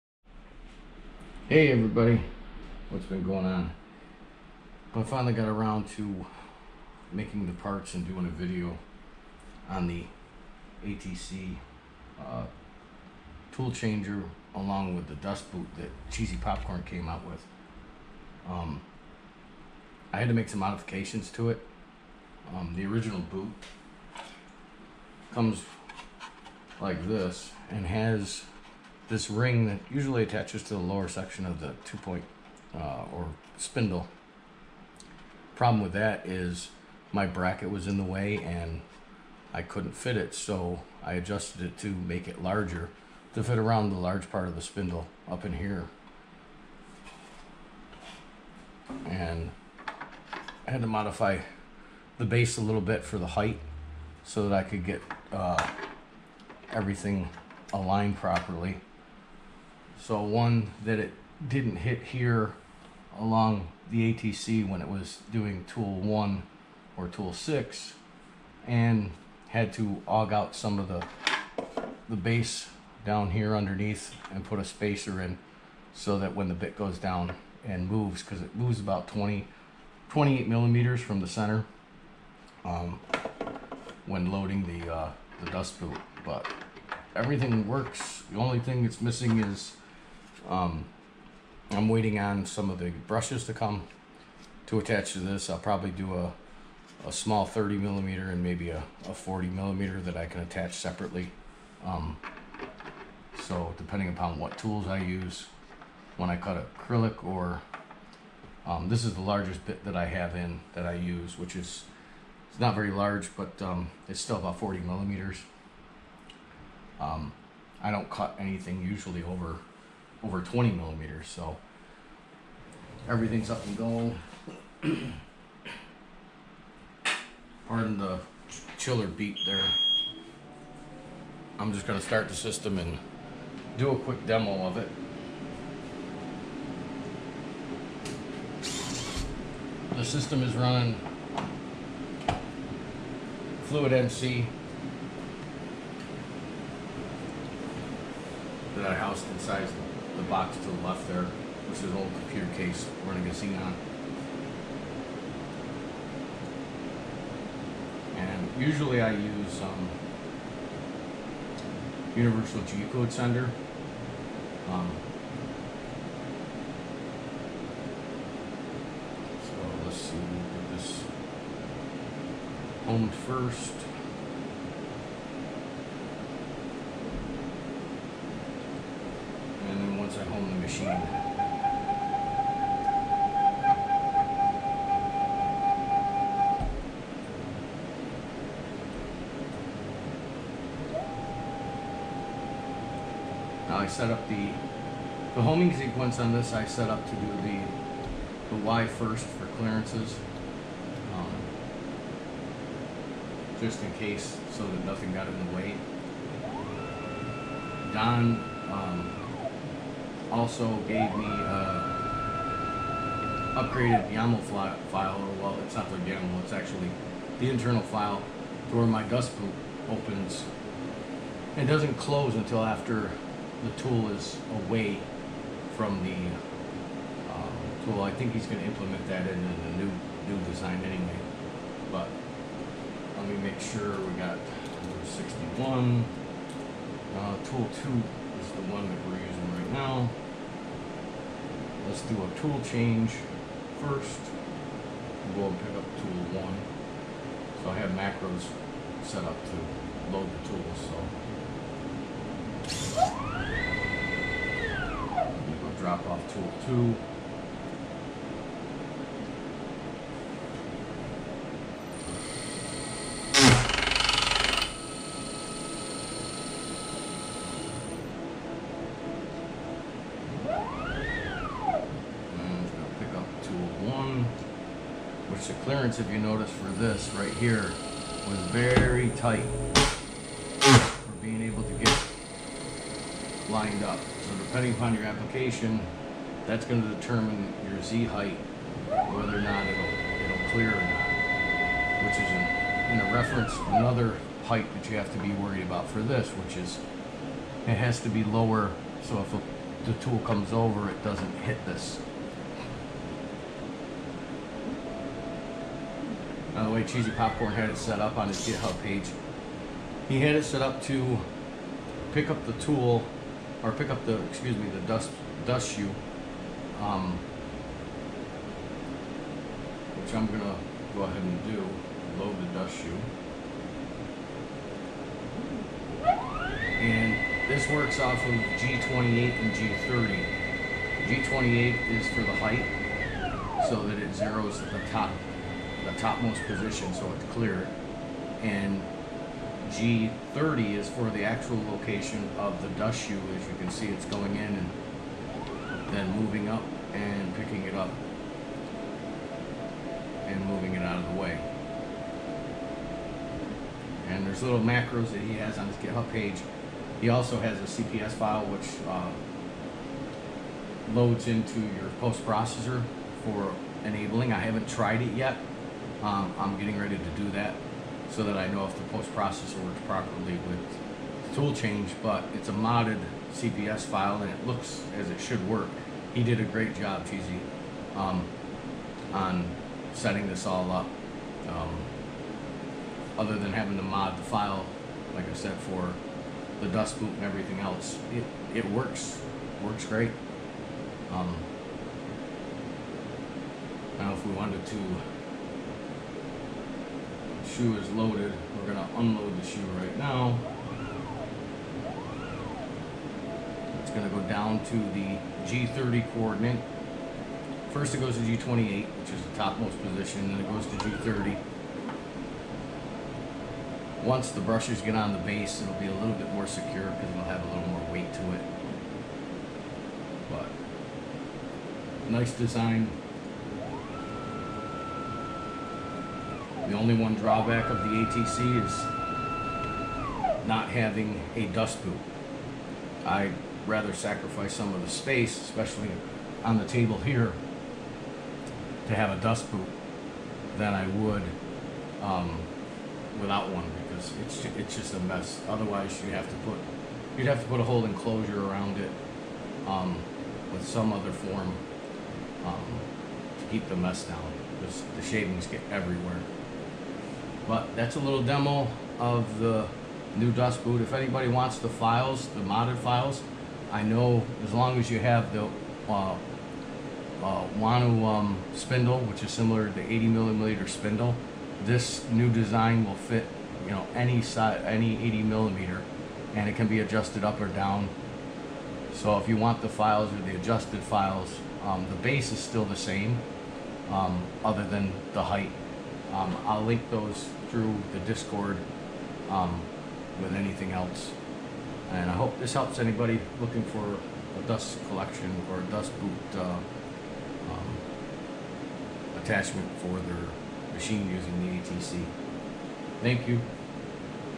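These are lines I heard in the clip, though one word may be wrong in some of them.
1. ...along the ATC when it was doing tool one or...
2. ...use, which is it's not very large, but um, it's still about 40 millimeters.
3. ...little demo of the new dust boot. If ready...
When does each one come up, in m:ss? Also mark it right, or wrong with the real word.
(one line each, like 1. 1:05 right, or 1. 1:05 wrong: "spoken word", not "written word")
1. 1:03 right
2. 1:50 right
3. 7:37 wrong: "anybody", not "ready".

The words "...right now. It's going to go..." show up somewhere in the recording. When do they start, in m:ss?
6:39.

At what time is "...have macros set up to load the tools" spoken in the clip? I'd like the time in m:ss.
4:07.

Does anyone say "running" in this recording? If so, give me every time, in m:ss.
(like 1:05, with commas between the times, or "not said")
2:20, 2:33.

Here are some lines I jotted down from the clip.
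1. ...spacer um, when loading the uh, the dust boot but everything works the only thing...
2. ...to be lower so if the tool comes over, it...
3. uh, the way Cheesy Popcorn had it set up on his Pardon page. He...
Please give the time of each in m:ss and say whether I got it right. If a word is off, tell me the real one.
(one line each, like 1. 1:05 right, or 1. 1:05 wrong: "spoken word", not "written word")
1. 1:21 wrong: "center", not "spacer"
2. 4:58 right
3. 5:06 wrong: "GitHub", not "Pardon".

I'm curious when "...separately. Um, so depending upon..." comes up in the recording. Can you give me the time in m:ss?
1:40.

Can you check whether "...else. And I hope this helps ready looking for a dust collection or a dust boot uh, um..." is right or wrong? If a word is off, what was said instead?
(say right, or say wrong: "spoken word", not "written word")
wrong: "anybody", not "ready".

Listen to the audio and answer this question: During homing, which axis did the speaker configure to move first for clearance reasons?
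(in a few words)
Y.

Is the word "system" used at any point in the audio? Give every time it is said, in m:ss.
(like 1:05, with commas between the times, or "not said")
2:12, 2:20.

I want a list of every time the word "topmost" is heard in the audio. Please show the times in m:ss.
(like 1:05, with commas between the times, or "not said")
5:35, 6:49.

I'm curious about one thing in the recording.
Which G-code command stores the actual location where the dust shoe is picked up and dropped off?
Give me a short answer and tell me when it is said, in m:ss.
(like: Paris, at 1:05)
G30, at 5:39.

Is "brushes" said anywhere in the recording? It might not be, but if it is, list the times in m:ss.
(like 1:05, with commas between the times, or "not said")
1:33, 6:54.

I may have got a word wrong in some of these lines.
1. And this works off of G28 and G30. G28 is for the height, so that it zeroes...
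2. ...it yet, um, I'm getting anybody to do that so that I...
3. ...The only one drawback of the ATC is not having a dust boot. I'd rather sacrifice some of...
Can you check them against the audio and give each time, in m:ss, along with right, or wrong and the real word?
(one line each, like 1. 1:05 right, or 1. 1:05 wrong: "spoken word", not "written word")
1. 5:26 right
2. 6:05 wrong: "ready", not "anybody"
3. 7:06 right.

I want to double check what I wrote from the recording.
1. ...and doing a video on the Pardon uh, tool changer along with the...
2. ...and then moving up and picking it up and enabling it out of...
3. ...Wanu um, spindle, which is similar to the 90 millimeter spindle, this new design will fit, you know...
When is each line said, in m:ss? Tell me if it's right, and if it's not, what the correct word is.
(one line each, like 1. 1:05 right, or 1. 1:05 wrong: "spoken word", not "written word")
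1. 0:07 wrong: "ATC", not "Pardon"
2. 5:44 wrong: "moving", not "enabling"
3. 7:47 wrong: "80", not "90".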